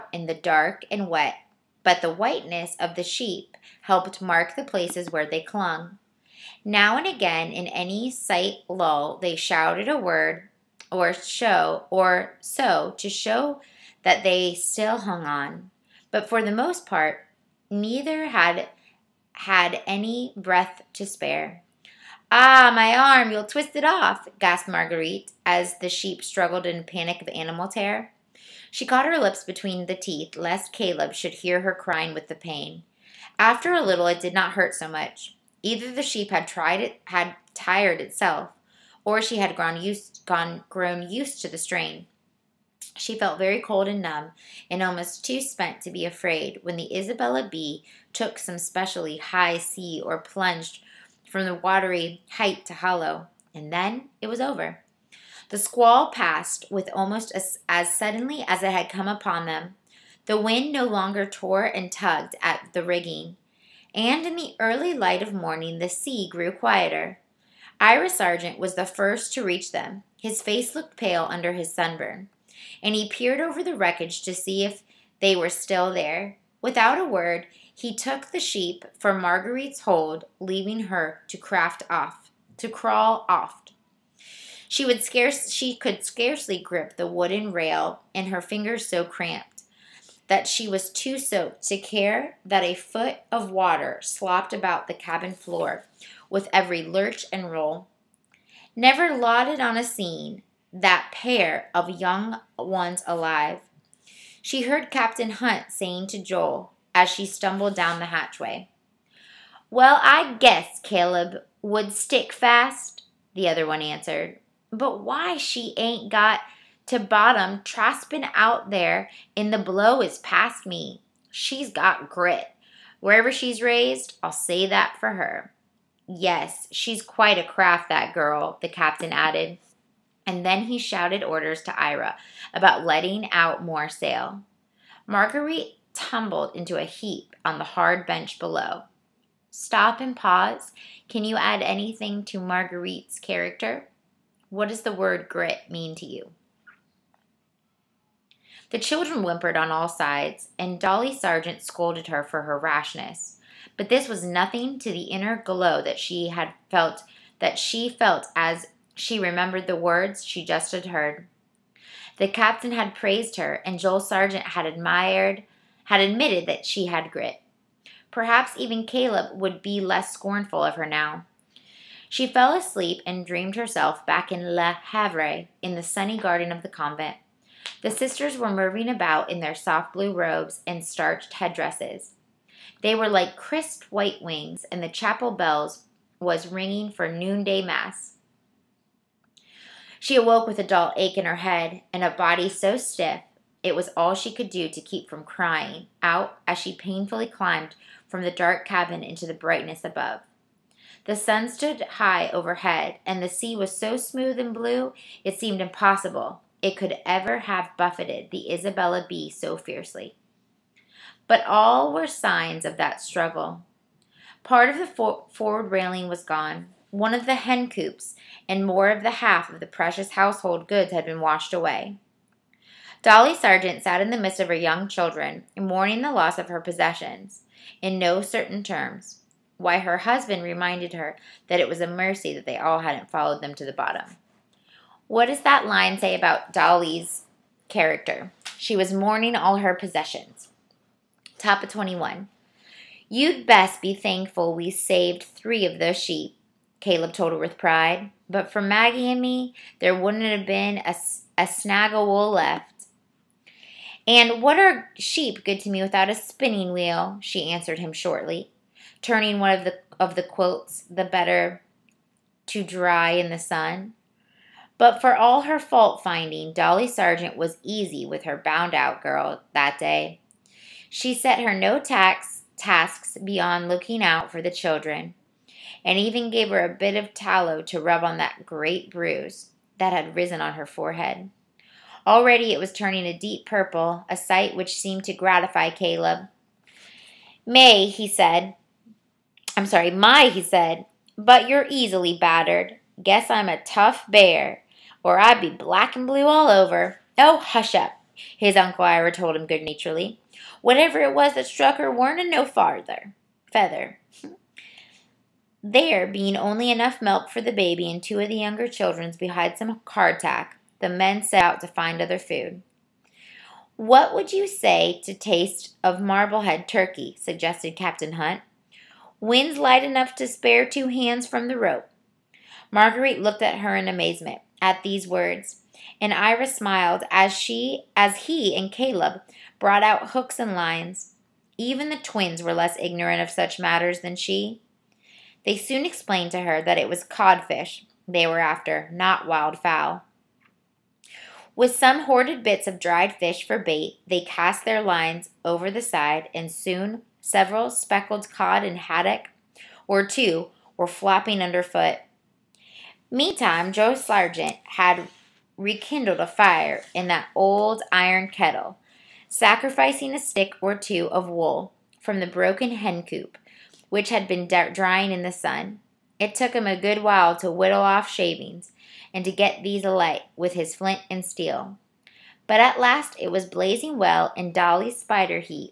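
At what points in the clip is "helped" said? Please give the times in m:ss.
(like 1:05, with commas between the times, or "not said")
0:03.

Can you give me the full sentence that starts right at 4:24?
But for all her fault finding, Dolly Sargent was easy with her bound out girl that day.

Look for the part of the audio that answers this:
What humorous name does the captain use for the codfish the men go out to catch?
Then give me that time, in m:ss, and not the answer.
5:16.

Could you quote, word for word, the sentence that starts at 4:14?
And what are sheep good to me without a spinning wheel?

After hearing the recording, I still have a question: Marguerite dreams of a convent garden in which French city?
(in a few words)
Le Havre.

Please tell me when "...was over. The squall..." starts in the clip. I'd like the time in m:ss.
0:54.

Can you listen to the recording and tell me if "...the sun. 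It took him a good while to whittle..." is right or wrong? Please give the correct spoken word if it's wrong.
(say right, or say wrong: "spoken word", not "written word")
right.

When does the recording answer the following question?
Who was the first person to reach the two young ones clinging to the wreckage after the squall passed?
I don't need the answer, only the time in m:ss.
1:07.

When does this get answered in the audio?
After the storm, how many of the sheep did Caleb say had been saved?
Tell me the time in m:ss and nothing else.
4:05.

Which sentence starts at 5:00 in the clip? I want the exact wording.
Whatever it was that struck her weren't a no farther feather.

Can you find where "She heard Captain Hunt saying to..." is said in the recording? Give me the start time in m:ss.
1:44.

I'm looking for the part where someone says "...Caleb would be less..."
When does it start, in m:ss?
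2:48.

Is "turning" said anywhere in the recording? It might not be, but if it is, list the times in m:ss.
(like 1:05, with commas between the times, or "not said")
4:19, 4:42.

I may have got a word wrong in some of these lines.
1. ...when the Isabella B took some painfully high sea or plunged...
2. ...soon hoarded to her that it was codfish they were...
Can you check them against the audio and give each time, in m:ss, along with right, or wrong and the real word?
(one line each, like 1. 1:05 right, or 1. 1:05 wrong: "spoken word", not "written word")
1. 0:46 wrong: "specially", not "painfully"
2. 5:35 wrong: "explained", not "hoarded".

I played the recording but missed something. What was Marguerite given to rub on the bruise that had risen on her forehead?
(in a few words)
tallow.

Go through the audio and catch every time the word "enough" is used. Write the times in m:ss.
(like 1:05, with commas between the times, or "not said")
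5:06, 5:19.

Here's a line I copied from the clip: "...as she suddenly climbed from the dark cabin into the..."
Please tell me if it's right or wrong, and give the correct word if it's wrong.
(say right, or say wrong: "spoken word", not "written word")
wrong: "painfully", not "suddenly".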